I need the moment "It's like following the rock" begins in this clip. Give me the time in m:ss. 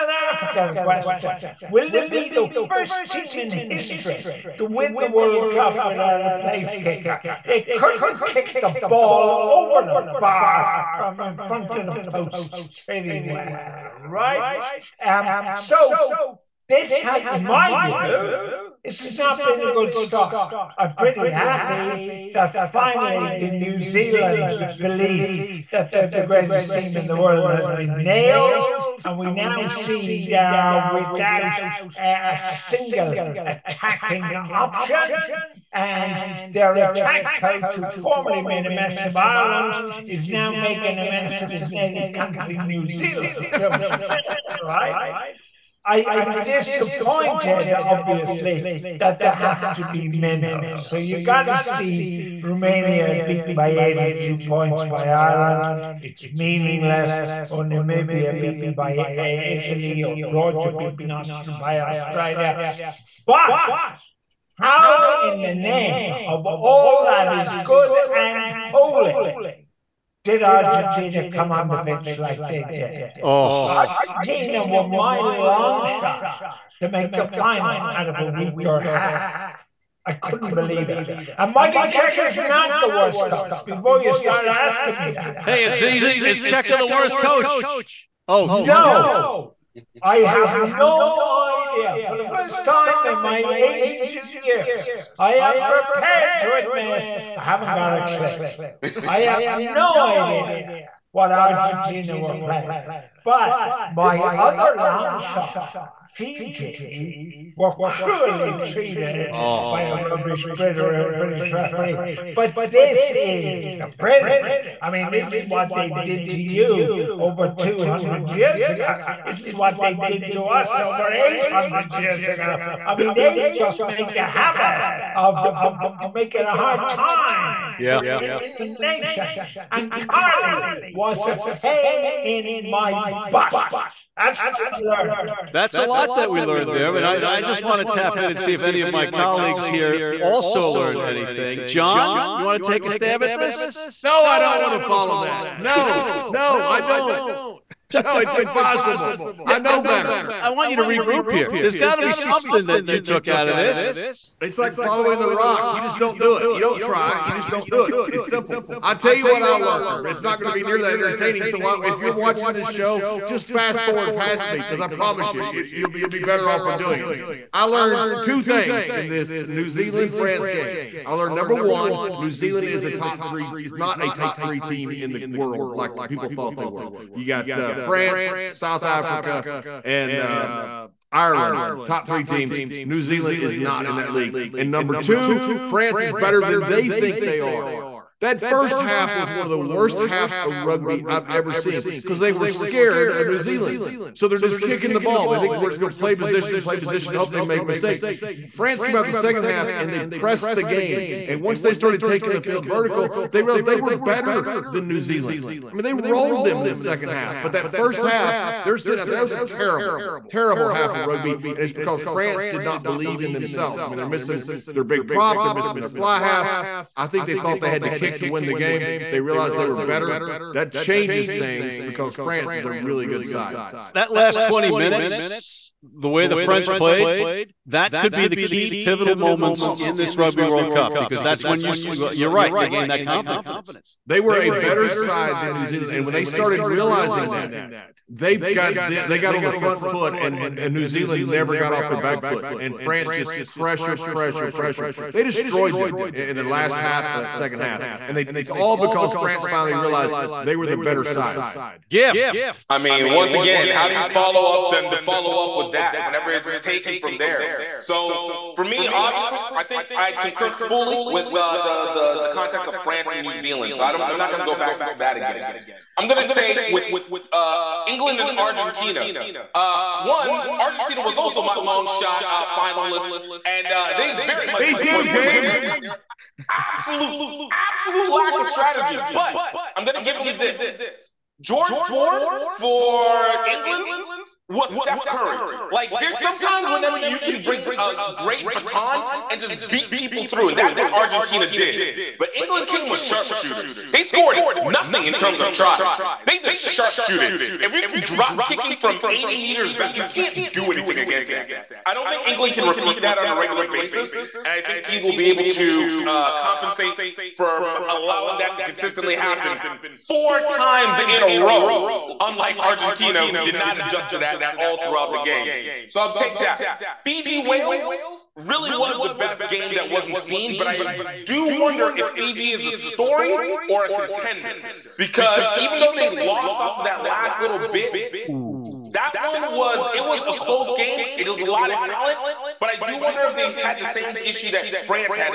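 2:34.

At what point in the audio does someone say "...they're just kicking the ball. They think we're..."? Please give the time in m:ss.
3:14.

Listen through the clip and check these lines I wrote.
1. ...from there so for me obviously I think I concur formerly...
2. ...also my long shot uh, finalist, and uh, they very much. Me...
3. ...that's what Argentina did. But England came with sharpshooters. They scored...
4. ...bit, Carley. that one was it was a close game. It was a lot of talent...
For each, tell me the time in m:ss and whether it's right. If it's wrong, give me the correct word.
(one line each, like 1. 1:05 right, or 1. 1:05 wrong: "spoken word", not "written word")
1. 4:16 wrong: "fully", not "formerly"
2. 4:31 right
3. 4:50 right
4. 5:27 wrong: "Ooh", not "Carley".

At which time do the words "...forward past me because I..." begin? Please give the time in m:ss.
2:43.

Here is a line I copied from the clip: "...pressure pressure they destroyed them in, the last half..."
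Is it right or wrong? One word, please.
right.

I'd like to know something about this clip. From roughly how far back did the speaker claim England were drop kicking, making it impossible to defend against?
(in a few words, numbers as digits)
80 meters.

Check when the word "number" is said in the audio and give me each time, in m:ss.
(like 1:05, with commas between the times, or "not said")
2:51, 3:04.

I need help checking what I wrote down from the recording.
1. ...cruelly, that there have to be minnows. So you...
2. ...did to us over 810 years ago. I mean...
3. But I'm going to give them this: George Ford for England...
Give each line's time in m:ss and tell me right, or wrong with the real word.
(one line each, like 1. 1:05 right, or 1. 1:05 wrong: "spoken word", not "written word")
1. 0:47 wrong: "obviously", not "cruelly"
2. 1:59 wrong: "800", not "810"
3. 4:39 right.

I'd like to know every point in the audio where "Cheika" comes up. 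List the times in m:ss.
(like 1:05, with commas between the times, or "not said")
1:26.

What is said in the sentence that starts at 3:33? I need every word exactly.
I mean, they're missing their big prop, they're missing their fly half.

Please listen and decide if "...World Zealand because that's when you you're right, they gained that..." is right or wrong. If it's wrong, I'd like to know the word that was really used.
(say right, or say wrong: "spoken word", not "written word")
wrong: "Cup", not "Zealand".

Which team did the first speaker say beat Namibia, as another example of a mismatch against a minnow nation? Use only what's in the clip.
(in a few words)
Italy.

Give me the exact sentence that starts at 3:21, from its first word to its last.
And once they started taking the field vertical, they realized they were better than New Zealand.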